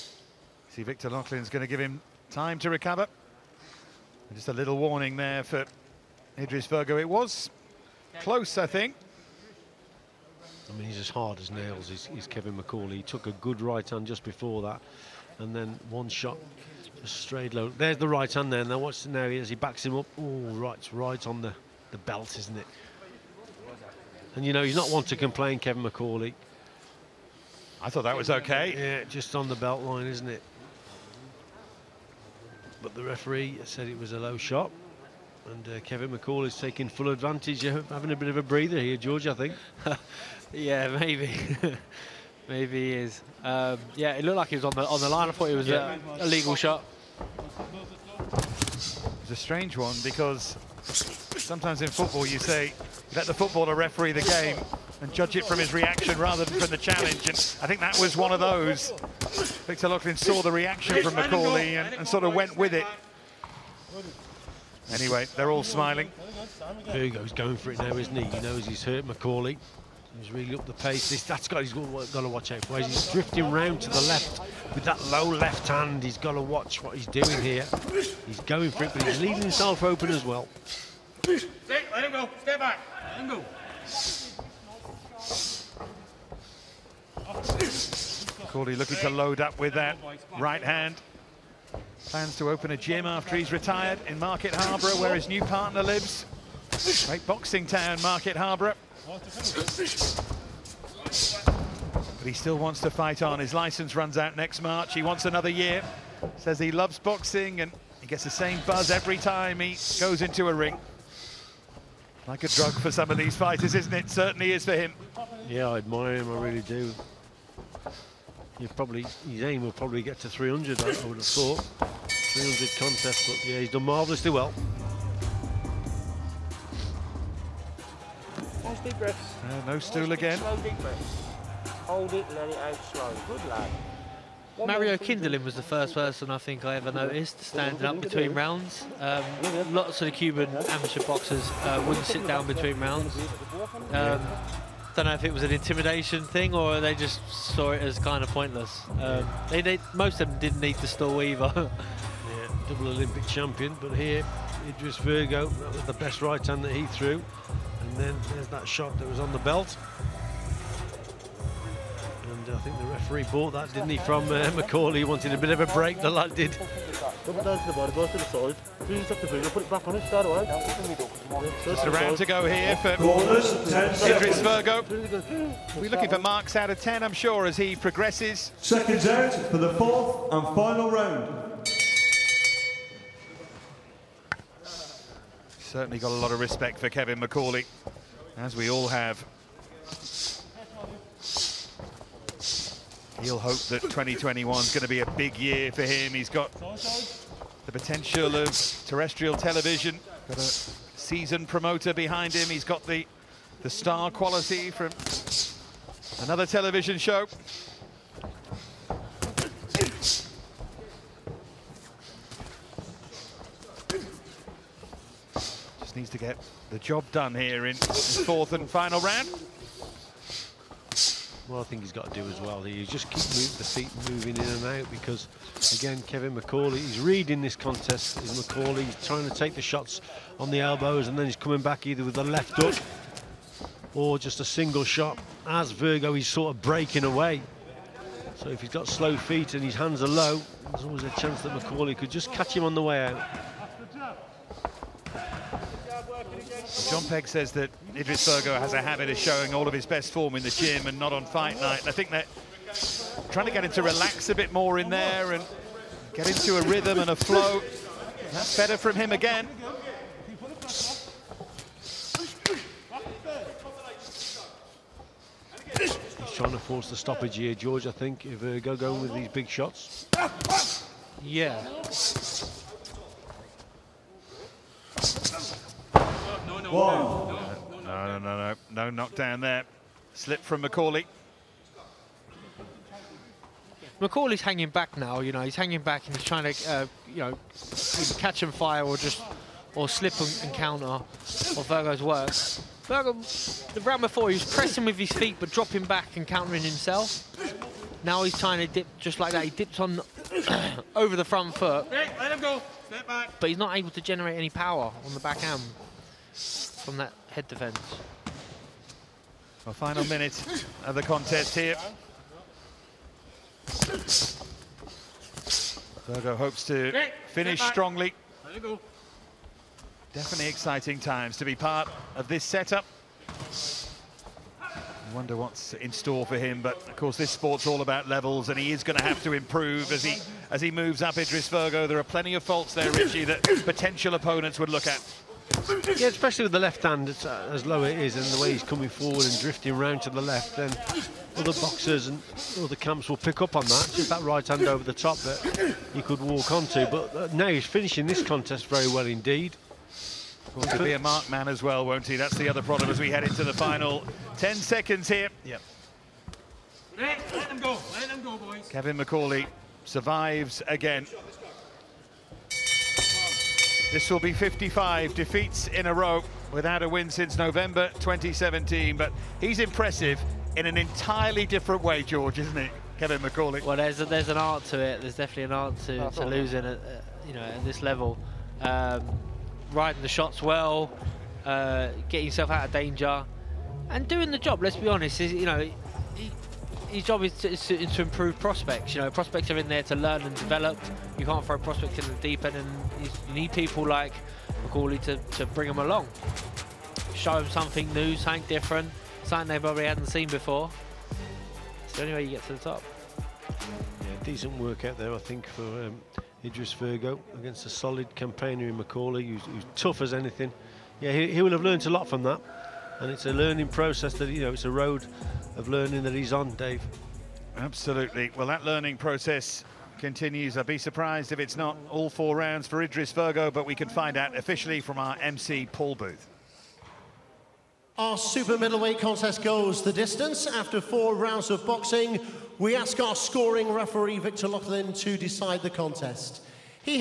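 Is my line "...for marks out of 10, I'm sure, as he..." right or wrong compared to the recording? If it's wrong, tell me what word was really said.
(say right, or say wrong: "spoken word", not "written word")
right.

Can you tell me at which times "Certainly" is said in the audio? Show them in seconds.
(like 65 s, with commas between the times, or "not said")
114 s, 185 s.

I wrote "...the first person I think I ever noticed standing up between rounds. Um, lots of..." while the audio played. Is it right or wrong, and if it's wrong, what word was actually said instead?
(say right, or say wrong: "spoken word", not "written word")
right.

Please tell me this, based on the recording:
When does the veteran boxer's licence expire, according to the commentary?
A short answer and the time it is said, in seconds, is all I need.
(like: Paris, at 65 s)
next March, at 104 s.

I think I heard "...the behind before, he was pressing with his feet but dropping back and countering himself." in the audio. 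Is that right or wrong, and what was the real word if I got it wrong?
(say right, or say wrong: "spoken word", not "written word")
wrong: "round", not "behind".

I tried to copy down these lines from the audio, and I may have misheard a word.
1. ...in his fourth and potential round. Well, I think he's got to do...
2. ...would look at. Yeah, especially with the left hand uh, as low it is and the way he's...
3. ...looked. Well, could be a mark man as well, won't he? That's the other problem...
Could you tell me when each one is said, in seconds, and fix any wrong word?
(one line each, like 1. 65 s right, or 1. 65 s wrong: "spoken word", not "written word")
1. 217 s wrong: "final", not "potential"
2. 334 s right
3. 349 s wrong: "indeed", not "looked".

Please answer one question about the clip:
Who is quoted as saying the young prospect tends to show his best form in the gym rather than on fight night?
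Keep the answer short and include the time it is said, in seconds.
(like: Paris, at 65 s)
John Pegg, at 246 s.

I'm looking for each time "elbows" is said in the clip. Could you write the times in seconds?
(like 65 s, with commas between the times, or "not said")
230 s.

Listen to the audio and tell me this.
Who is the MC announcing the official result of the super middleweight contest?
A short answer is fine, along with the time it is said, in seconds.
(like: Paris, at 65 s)
Paul Booth, at 425 s.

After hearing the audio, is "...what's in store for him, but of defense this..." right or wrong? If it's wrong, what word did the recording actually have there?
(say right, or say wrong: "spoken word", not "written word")
wrong: "course", not "defense".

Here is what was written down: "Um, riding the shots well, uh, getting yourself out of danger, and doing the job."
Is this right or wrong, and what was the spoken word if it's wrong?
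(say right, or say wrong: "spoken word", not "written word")
right.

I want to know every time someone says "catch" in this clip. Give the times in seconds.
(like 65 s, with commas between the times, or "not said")
242 s, 288 s.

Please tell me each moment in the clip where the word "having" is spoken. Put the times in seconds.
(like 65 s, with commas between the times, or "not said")
37 s.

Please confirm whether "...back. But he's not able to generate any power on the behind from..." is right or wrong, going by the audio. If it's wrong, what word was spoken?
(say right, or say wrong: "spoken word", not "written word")
wrong: "backhand", not "behind".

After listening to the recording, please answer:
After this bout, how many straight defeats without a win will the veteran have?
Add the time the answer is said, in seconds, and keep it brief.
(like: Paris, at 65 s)
55, at 364 s.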